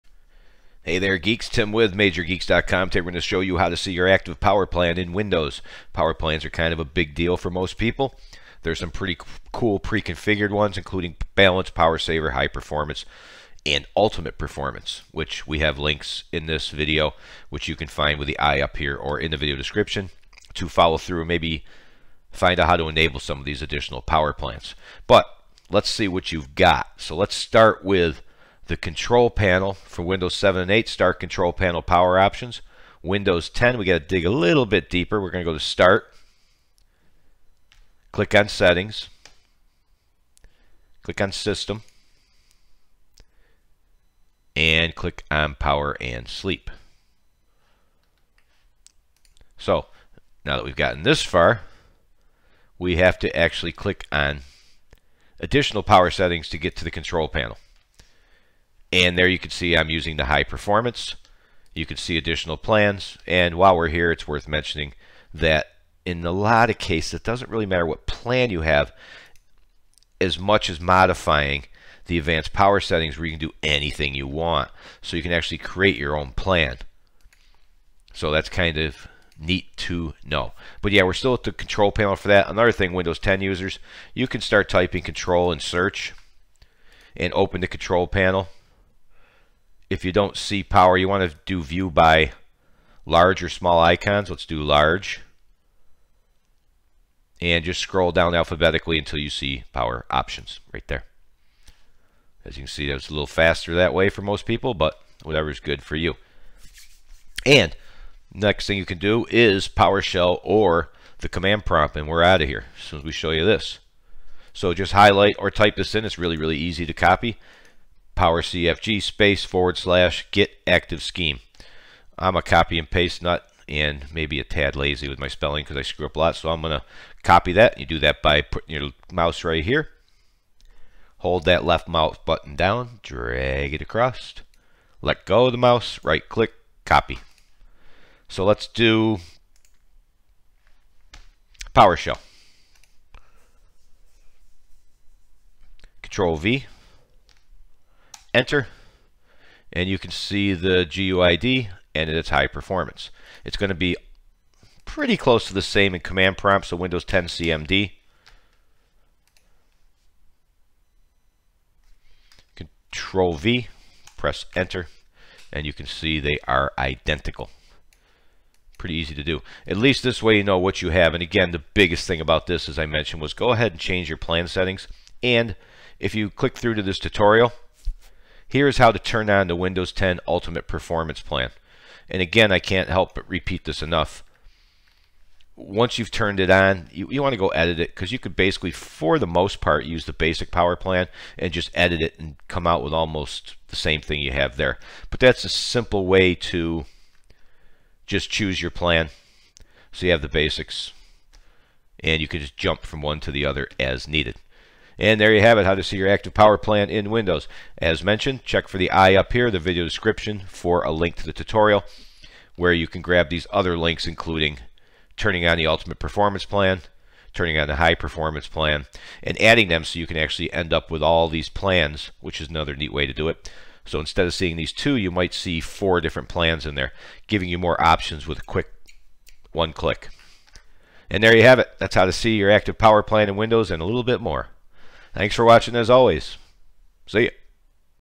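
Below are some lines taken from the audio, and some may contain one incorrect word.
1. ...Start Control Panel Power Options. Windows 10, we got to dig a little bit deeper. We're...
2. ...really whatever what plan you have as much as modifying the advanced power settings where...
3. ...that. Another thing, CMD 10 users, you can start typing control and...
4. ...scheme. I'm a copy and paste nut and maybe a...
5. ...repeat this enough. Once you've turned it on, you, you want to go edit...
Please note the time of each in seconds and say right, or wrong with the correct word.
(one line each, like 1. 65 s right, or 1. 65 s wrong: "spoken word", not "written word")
1. 30 s right
2. 67 s wrong: "matter", not "whatever"
3. 82 s wrong: "Windows", not "CMD"
4. 121 s right
5. 183 s right.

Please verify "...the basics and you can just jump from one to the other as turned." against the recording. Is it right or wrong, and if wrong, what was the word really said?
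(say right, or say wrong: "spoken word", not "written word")
wrong: "needed", not "turned".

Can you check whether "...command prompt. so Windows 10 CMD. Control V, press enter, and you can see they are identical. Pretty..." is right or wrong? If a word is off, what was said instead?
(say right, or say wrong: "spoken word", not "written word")
right.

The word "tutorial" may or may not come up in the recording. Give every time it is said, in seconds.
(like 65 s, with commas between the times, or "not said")
176 s, 211 s.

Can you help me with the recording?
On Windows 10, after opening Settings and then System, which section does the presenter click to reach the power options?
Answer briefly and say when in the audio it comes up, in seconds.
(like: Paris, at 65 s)
Power and Sleep, at 45 s.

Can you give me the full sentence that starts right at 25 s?
But let's see what you've got.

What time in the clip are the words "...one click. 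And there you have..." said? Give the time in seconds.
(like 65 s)
229 s.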